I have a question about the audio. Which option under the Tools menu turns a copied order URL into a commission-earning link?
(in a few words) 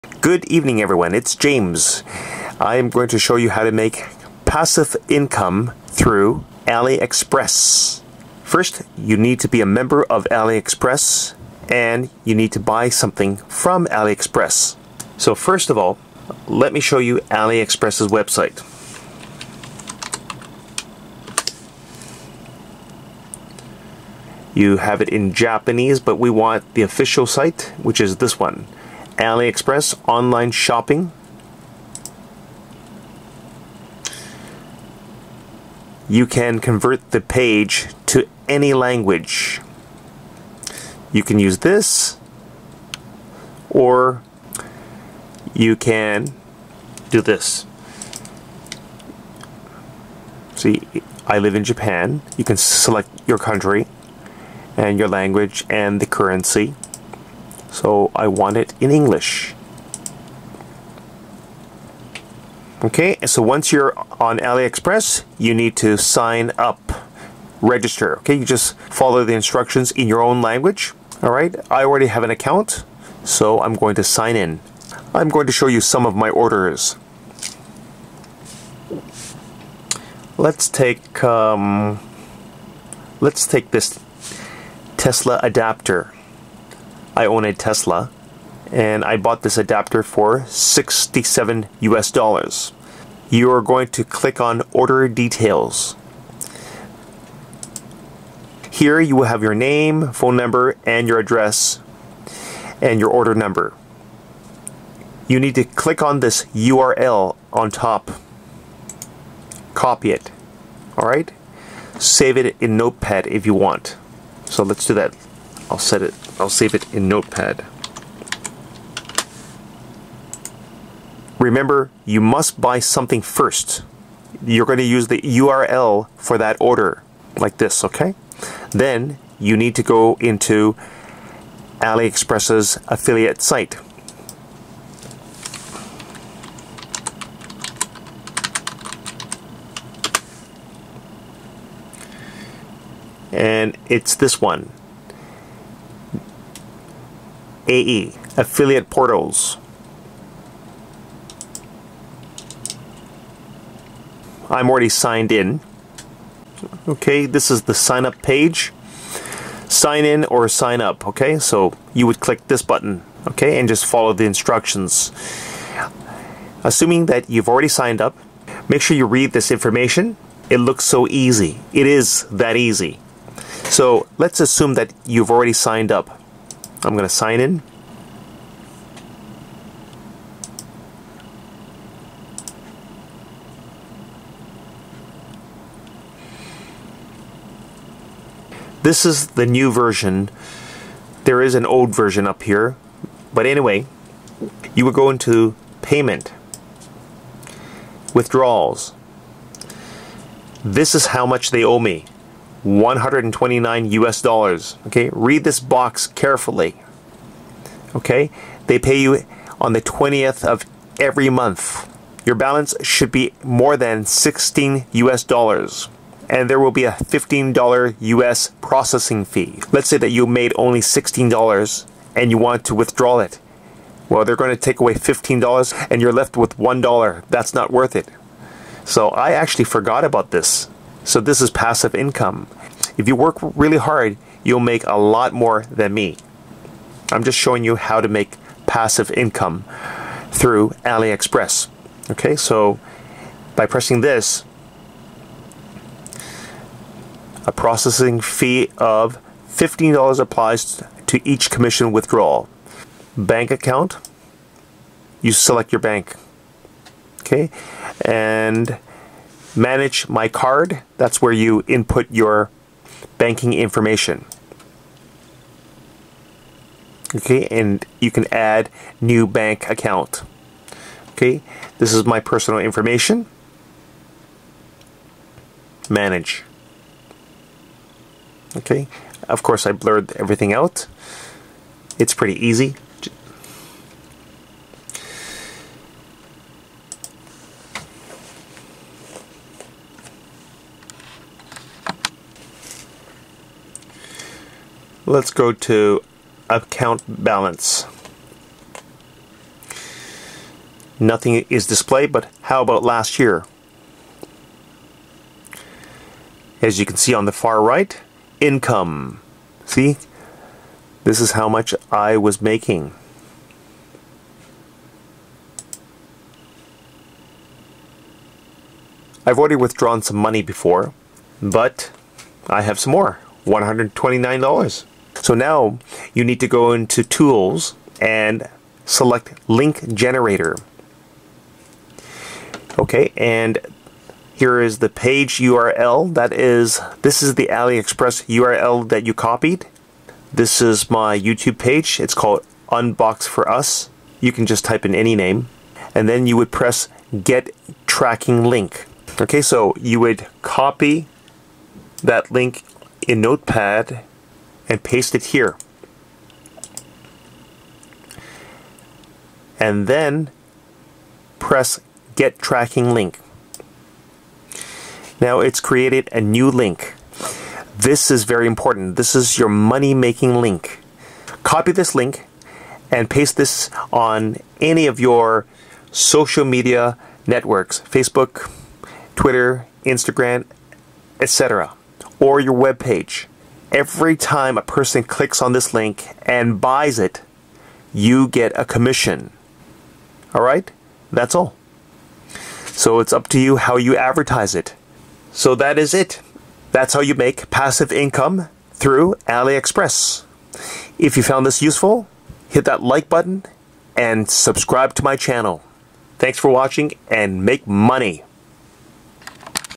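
Link Generator.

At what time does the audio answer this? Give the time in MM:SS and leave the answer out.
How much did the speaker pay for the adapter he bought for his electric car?
01:30.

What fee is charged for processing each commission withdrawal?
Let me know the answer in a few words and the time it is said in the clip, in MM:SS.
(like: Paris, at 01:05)
$15, at 03:36.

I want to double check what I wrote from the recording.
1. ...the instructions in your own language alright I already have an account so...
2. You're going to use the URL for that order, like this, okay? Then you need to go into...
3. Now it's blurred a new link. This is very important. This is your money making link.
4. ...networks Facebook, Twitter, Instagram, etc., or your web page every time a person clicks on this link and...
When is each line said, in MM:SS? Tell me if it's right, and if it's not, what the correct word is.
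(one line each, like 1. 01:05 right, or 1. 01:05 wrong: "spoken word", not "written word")
1. 01:09 right
2. 02:04 right
3. 06:05 wrong: "created", not "blurred"
4. 06:17 right.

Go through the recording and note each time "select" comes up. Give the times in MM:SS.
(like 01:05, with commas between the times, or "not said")
00:52, 04:15, 05:28.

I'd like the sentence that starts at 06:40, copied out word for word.
If you found this useful, hit that like button and subscribe to my channel.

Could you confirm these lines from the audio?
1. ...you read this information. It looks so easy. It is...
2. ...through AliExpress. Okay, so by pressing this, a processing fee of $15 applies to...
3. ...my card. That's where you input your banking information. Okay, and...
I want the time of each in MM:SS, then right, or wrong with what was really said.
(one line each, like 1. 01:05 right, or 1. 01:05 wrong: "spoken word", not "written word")
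1. 02:48 right
2. 04:00 right
3. 04:20 right.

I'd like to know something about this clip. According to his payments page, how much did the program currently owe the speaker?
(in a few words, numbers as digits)
$129.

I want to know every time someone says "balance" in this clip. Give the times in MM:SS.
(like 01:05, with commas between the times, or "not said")
03:32, 04:57.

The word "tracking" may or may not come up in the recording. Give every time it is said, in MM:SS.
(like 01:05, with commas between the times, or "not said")
05:47, 06:02.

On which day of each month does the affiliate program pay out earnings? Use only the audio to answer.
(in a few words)
20th.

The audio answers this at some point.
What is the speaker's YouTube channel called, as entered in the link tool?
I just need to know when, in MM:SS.
05:42.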